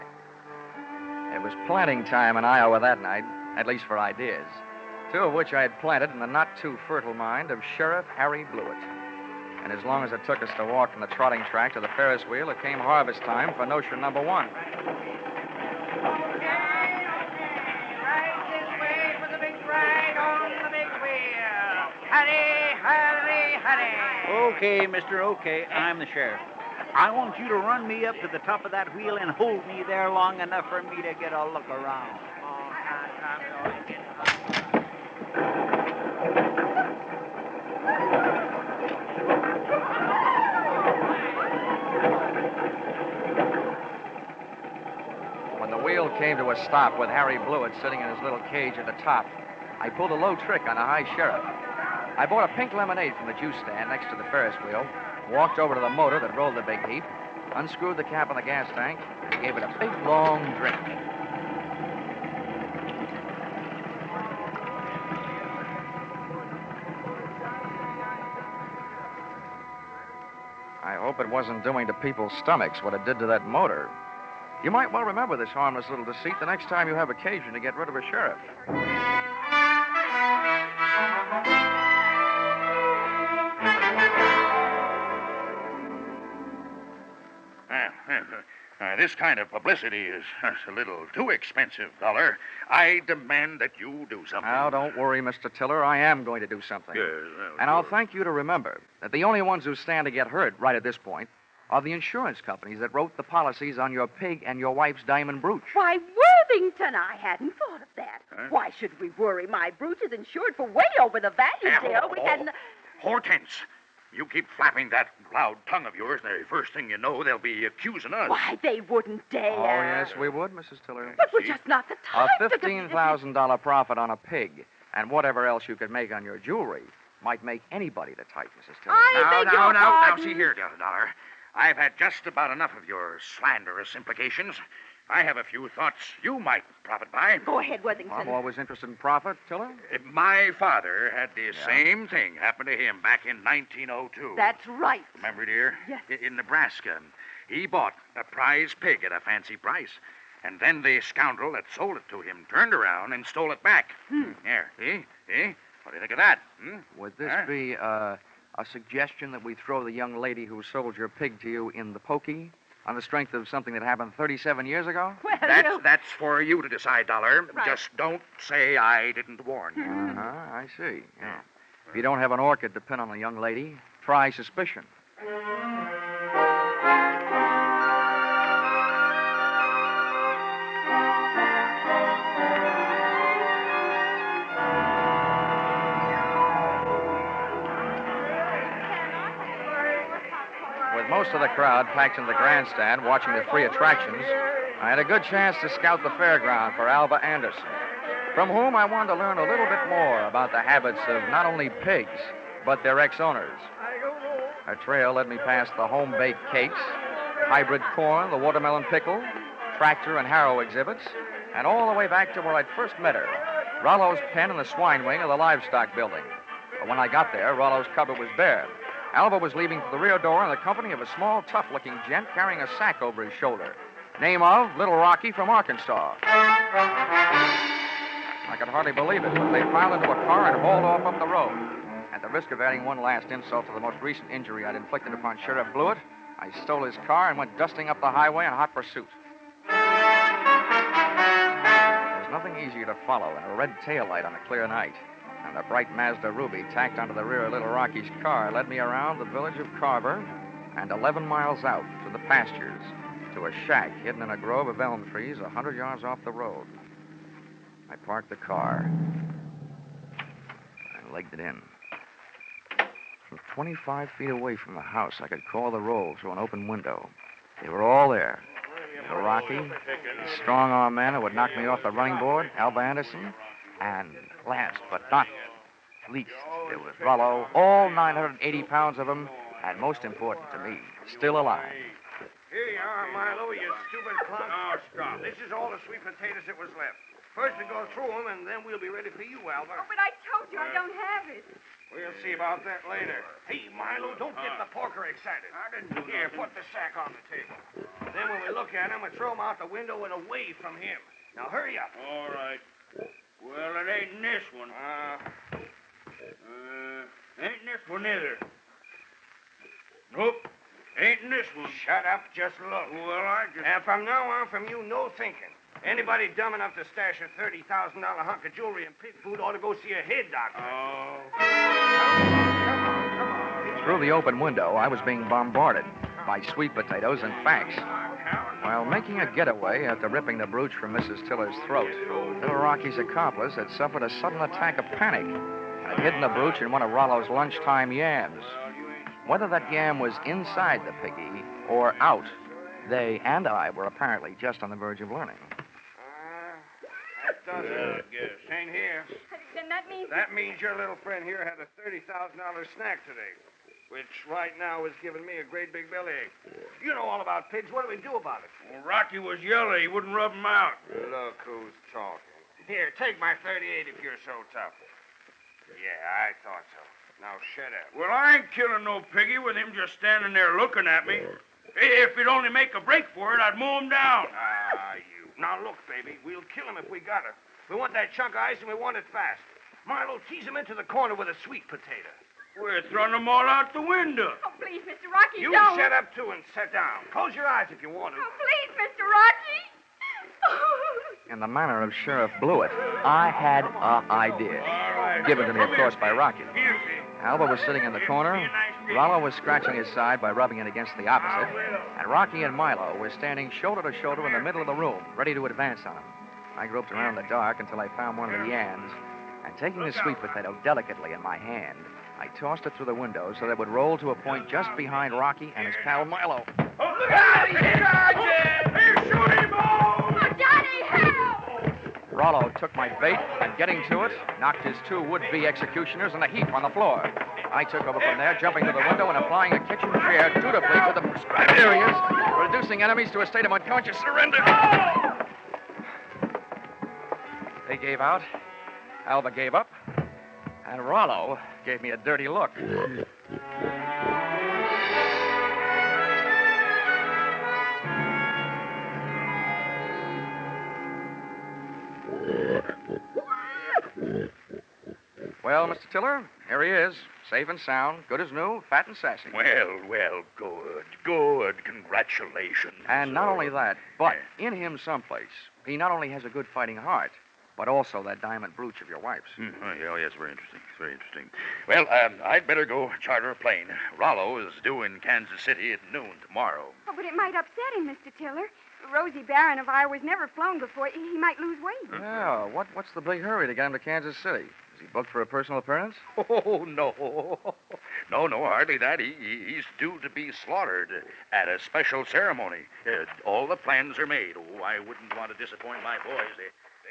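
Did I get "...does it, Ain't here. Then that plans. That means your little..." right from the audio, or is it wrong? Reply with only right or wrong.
wrong.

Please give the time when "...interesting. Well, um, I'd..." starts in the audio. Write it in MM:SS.
07:50.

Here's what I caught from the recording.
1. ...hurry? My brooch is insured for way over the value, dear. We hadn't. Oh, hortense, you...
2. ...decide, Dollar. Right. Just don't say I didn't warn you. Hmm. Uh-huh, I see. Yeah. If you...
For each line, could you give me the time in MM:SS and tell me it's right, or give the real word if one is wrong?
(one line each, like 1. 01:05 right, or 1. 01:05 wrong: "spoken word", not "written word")
1. 01:49 wrong: "worry", not "hurry"
2. 02:46 right.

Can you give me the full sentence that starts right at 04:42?
Here you are, Milo, you stupid clown.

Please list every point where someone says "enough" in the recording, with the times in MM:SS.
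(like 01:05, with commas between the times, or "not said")
00:30, 02:12, 05:16.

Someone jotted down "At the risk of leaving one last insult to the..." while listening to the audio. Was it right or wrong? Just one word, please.
wrong.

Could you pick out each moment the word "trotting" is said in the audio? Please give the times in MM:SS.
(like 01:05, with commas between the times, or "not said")
00:11.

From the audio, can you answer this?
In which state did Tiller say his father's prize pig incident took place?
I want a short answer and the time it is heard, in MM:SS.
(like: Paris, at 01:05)
Nebraska, at 02:26.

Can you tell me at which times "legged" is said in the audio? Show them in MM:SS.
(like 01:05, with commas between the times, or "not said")
04:21.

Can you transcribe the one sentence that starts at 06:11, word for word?
If he'd only make a break for it, I'd mow him down.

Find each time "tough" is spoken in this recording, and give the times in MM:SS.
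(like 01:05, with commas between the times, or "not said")
03:41, 06:04.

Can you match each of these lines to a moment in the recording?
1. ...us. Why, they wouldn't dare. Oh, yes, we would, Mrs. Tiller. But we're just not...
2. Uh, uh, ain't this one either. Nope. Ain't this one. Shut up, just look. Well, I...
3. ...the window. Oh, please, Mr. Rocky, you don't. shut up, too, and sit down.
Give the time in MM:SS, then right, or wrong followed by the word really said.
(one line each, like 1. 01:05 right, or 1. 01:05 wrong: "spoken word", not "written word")
1. 01:58 right
2. 05:04 right
3. 06:23 right.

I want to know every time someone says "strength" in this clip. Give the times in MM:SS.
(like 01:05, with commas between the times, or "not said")
02:43.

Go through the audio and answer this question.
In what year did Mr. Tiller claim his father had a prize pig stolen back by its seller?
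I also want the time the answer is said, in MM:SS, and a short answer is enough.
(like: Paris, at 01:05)
1902, at 02:23.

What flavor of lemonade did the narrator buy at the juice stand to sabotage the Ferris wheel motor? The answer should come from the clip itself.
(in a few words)
Pink.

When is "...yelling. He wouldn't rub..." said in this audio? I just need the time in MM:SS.
05:59.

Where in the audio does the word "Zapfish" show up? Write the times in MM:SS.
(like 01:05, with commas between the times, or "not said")
not said.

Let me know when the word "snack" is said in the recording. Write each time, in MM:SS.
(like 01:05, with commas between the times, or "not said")
05:52.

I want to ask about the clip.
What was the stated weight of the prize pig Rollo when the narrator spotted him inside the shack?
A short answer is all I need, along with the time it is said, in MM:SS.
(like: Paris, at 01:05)
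980 pounds, at 04:37.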